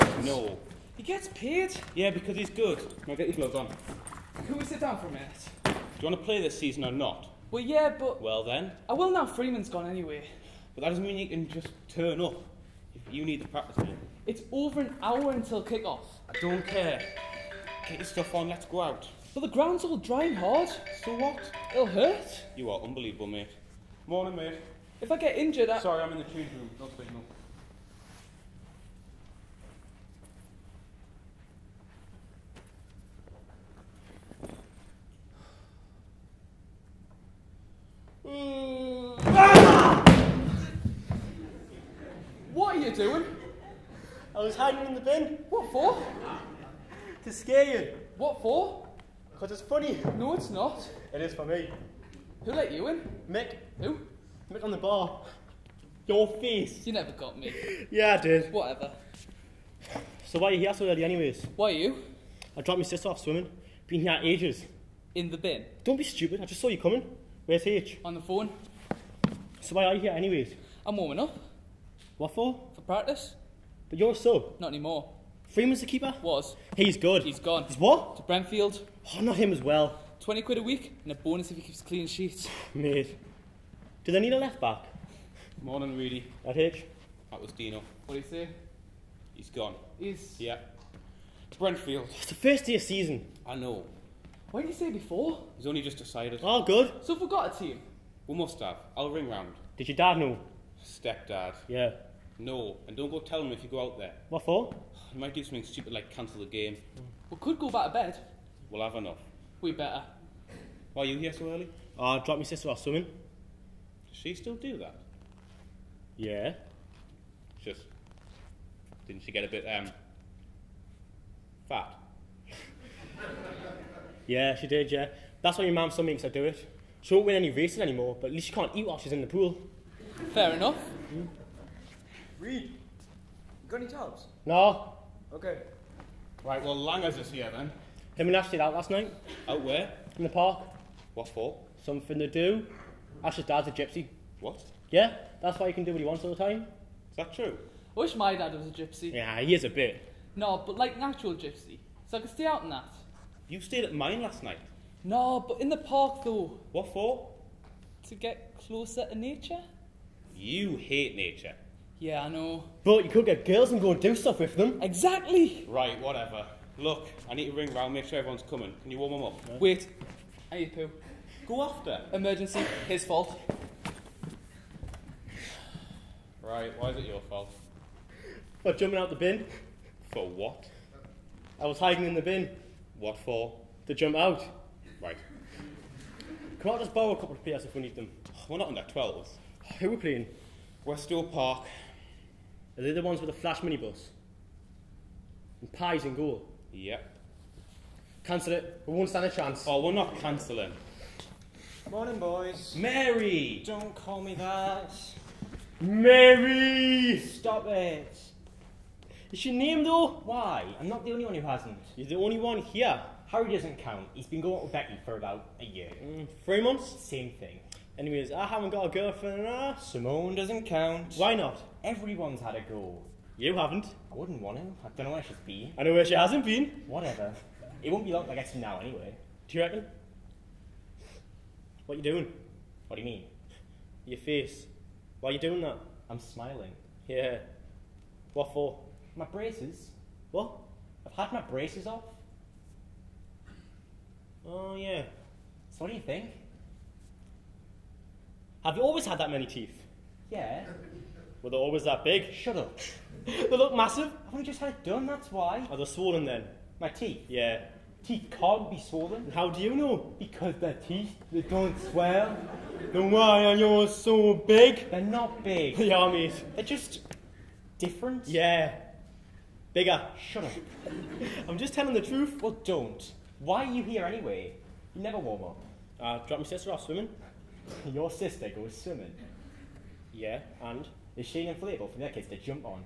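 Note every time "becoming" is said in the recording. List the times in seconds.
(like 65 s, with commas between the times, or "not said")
not said.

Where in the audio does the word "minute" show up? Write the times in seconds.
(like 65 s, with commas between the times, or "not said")
5 s.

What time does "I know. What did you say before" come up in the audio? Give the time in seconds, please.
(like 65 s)
93 s.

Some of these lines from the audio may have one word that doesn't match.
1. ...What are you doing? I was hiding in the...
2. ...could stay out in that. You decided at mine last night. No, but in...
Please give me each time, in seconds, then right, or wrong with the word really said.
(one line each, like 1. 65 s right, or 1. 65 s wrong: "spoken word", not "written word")
1. 42 s right
2. 152 s wrong: "stayed", not "decided".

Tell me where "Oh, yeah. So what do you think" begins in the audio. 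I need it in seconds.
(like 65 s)
244 s.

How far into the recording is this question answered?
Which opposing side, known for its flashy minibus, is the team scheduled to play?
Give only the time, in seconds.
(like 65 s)
190 s.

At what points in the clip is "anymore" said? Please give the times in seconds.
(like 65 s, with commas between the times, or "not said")
74 s, 127 s.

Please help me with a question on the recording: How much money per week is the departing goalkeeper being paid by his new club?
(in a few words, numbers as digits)
£20.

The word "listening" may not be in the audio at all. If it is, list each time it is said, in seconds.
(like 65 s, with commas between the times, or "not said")
not said.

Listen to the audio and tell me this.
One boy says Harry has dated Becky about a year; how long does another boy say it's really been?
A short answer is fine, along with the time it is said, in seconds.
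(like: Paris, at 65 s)
3 months, at 216 s.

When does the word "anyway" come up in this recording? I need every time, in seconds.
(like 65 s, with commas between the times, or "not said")
9 s, 61 s, 70 s, 217 s, 228 s, 274 s.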